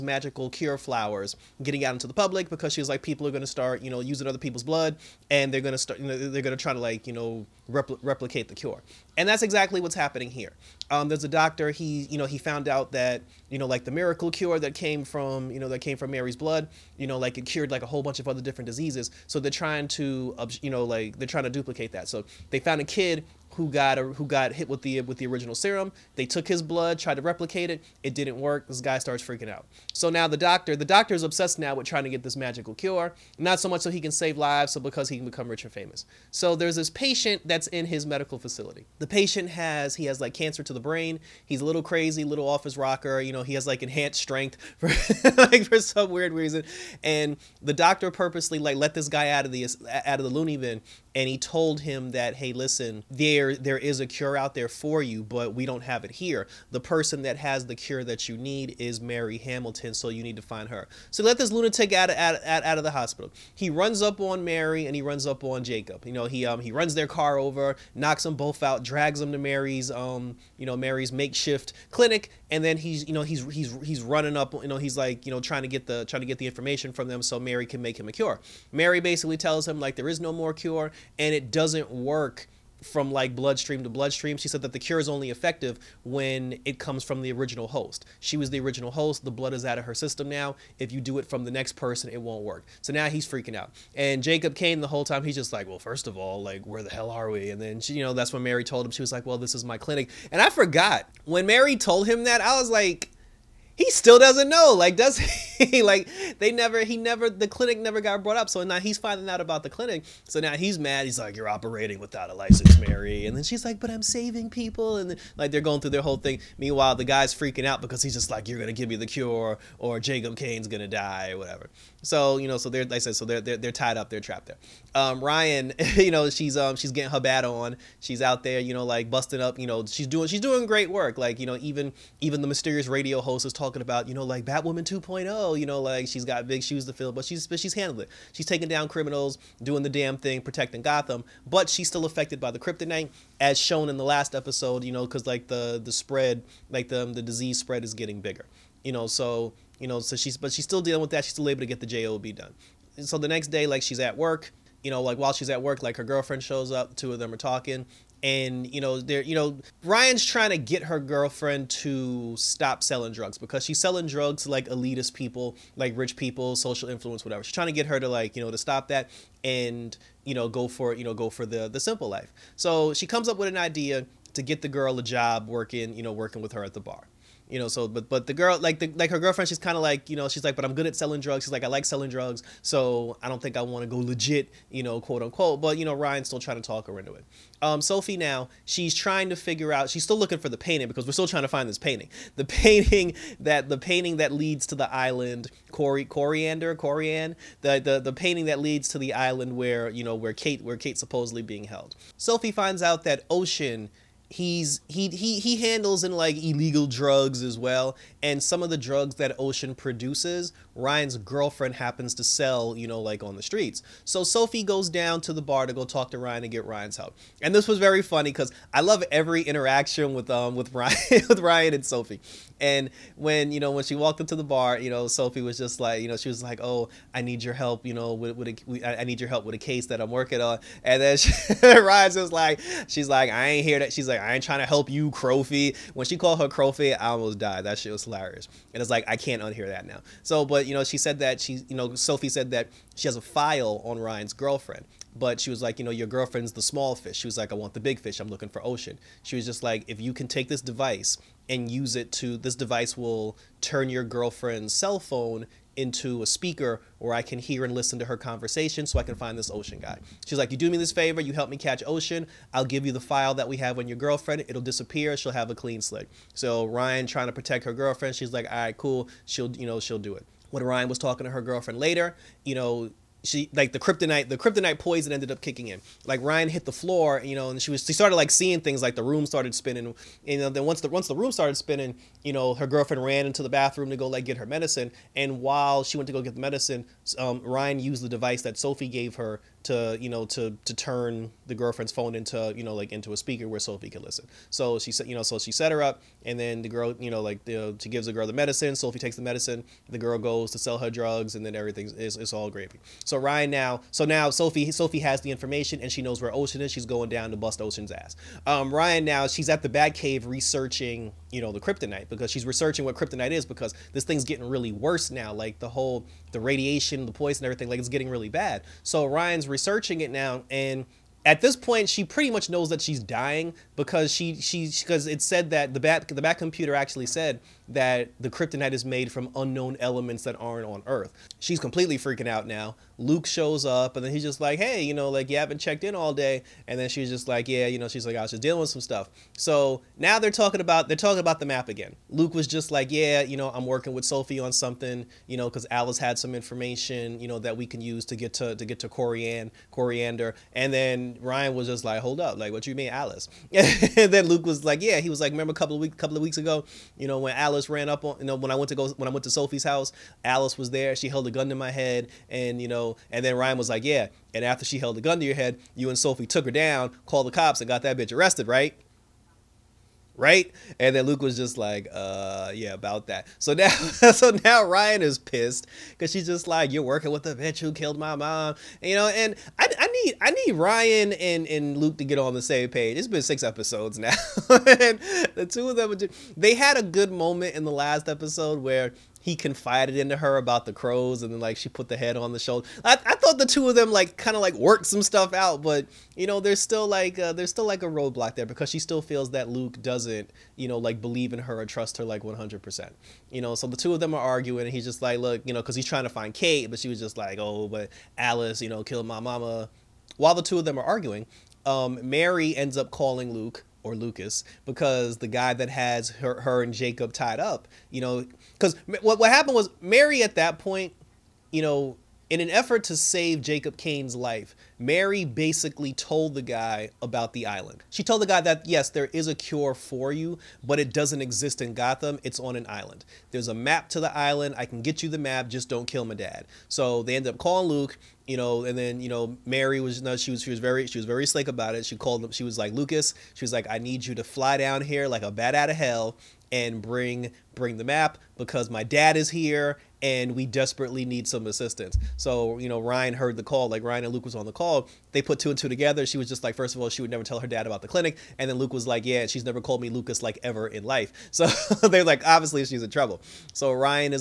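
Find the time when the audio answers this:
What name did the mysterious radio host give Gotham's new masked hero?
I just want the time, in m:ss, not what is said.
2:14.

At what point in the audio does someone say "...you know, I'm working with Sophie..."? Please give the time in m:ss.
5:43.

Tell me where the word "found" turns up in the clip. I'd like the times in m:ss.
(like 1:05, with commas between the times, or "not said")
0:12, 0:22.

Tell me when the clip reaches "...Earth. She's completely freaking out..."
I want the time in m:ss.
5:30.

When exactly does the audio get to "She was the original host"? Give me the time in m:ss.
1:28.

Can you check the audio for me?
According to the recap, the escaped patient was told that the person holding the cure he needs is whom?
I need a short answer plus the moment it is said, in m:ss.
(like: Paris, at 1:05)
Mary Hamilton, at 0:58.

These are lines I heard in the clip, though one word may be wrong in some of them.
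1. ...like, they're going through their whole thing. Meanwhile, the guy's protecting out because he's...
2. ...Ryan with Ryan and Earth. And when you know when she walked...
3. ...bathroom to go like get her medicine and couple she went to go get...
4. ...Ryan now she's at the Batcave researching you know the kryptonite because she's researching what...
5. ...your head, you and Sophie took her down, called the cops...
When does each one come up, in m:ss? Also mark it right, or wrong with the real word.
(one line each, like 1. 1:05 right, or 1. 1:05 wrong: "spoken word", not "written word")
1. 1:55 wrong: "freaking", not "protecting"
2. 3:40 wrong: "Sophie", not "Earth"
3. 4:43 wrong: "while", not "couple"
4. 5:08 right
5. 6:05 right.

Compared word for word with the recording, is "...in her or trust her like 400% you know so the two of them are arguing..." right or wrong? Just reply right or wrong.
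wrong.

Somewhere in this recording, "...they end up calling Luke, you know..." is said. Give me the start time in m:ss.
7:17.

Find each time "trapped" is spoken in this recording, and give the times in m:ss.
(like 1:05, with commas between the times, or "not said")
2:04.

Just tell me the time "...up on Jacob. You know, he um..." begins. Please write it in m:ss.
1:05.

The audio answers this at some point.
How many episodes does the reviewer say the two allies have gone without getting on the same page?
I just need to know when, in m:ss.
6:23.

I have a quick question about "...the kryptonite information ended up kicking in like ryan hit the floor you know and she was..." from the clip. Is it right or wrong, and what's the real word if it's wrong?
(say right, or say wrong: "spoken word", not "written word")
wrong: "poison", not "information".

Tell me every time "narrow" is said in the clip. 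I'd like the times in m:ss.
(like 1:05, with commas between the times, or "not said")
not said.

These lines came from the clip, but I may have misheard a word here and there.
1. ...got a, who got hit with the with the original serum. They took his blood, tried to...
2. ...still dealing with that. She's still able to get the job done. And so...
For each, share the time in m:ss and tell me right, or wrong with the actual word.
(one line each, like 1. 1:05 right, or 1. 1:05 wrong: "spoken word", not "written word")
1. 0:23 right
2. 2:30 right.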